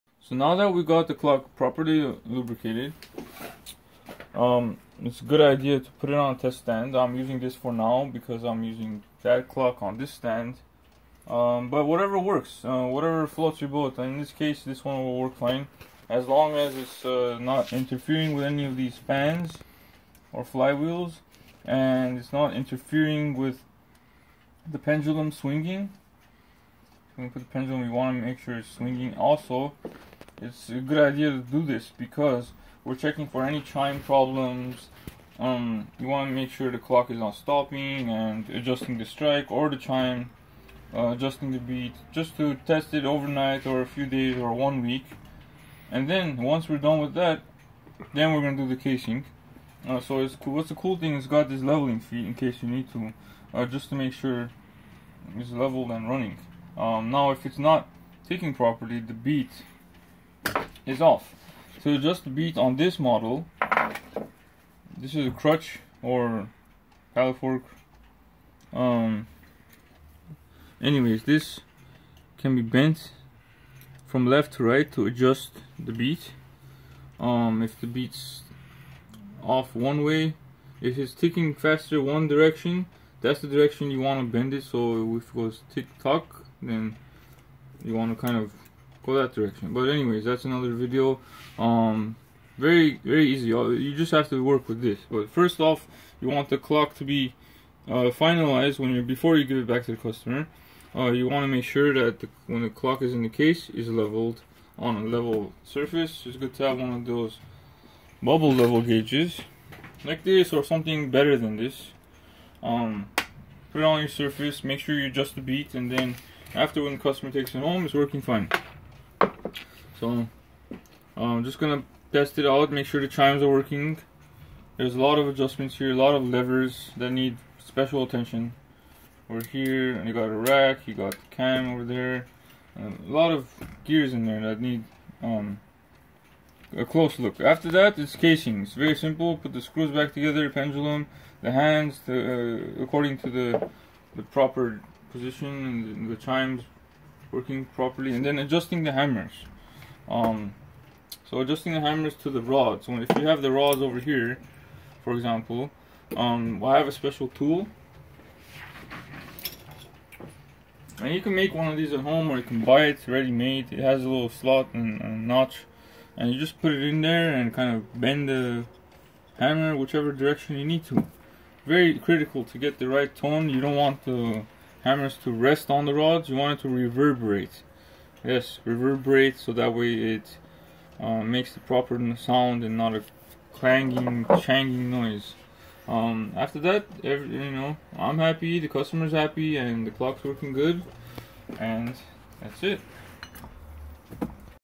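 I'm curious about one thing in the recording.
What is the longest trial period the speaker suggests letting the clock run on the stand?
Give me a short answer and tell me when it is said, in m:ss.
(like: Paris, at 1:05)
One week, at 0:44.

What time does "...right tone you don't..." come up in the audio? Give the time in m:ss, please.
2:52.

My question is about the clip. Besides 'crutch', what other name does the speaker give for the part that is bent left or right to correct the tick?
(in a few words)
Paddle fork.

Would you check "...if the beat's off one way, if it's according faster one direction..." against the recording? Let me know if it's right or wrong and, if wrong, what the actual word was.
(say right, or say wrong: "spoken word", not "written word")
wrong: "ticking", not "according".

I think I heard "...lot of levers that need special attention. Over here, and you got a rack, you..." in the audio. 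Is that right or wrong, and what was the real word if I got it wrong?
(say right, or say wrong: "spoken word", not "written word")
right.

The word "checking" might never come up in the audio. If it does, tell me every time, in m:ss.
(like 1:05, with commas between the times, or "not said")
0:32.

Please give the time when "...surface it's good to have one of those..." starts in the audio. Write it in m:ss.
1:45.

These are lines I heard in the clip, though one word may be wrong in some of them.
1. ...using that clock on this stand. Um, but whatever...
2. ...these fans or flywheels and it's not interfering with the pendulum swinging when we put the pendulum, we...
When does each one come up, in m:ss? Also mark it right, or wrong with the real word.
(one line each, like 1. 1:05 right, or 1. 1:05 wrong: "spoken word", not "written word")
1. 0:08 right
2. 0:18 right.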